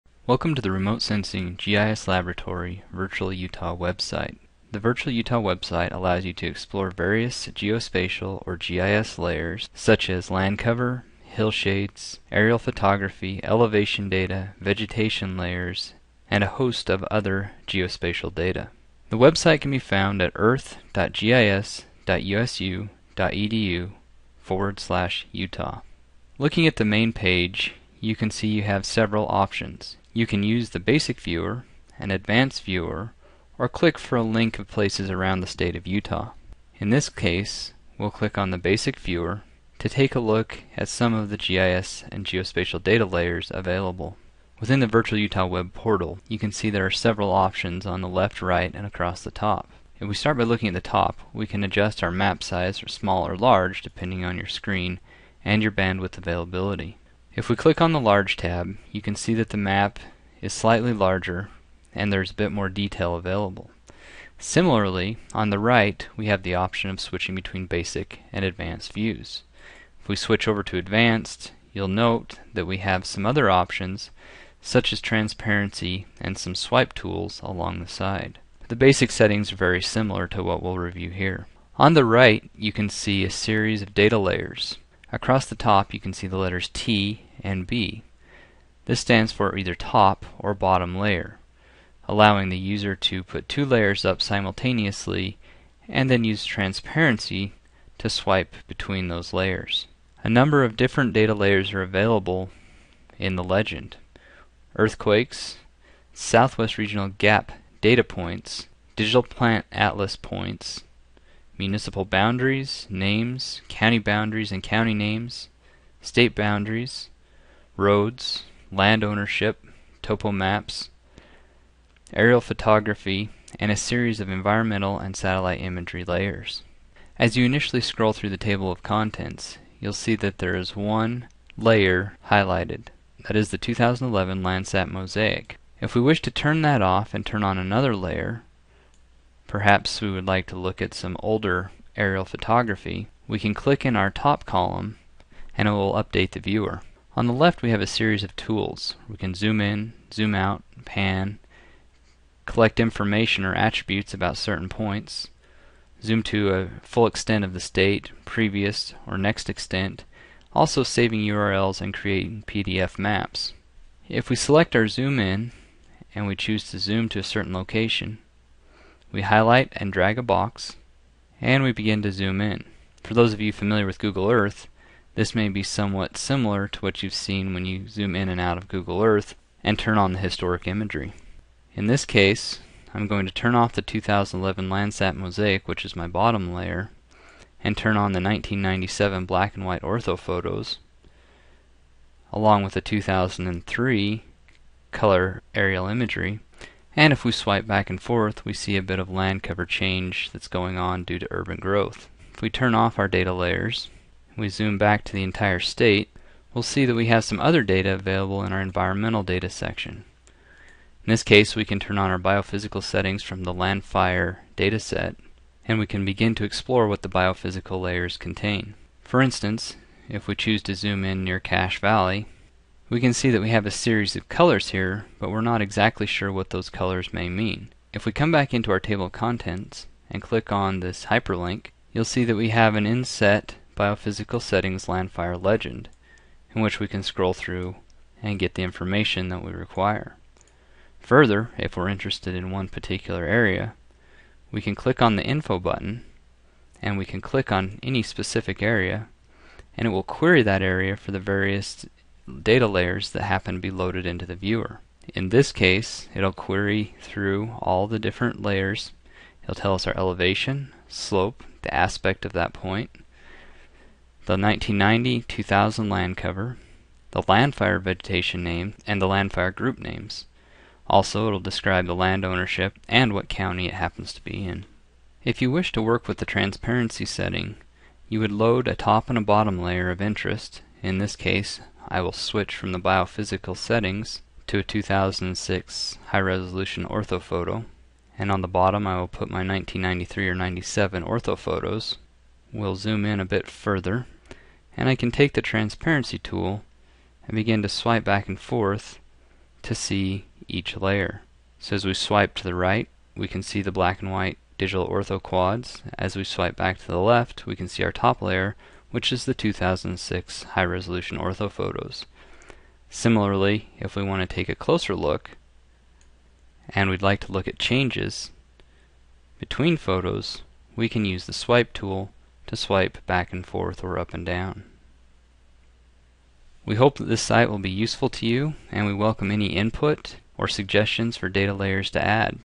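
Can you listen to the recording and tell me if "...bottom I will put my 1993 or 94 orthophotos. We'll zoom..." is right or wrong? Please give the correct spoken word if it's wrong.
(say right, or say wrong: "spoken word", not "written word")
wrong: "97", not "94".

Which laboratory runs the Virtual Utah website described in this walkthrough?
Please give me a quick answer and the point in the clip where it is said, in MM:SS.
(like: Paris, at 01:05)
Remote Sensing GIS Laboratory, at 00:00.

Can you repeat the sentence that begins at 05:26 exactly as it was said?
We hope that this site will be useful to you, and we welcome any input or suggestions for data layers to add.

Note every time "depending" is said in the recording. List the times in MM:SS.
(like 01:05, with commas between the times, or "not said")
00:53.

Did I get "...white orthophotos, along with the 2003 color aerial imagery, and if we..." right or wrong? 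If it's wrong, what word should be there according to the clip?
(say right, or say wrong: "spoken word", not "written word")
right.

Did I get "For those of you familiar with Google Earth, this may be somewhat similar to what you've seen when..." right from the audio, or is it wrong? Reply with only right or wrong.
right.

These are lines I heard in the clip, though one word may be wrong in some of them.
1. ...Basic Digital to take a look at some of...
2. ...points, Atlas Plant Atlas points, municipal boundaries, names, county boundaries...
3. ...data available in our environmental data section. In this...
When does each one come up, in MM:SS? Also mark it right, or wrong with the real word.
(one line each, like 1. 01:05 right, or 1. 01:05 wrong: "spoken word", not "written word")
1. 00:38 wrong: "Viewer", not "Digital"
2. 01:48 wrong: "Digital", not "Atlas"
3. 03:27 right.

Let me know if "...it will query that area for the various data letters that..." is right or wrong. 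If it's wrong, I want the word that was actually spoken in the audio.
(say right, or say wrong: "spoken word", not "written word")
wrong: "layers", not "letters".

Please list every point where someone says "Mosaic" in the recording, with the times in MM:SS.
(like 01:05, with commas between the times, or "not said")
02:14, 03:05.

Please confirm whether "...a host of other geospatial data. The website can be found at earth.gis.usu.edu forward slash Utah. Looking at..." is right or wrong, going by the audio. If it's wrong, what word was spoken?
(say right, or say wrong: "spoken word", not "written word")
right.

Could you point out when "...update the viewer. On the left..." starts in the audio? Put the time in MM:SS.
02:25.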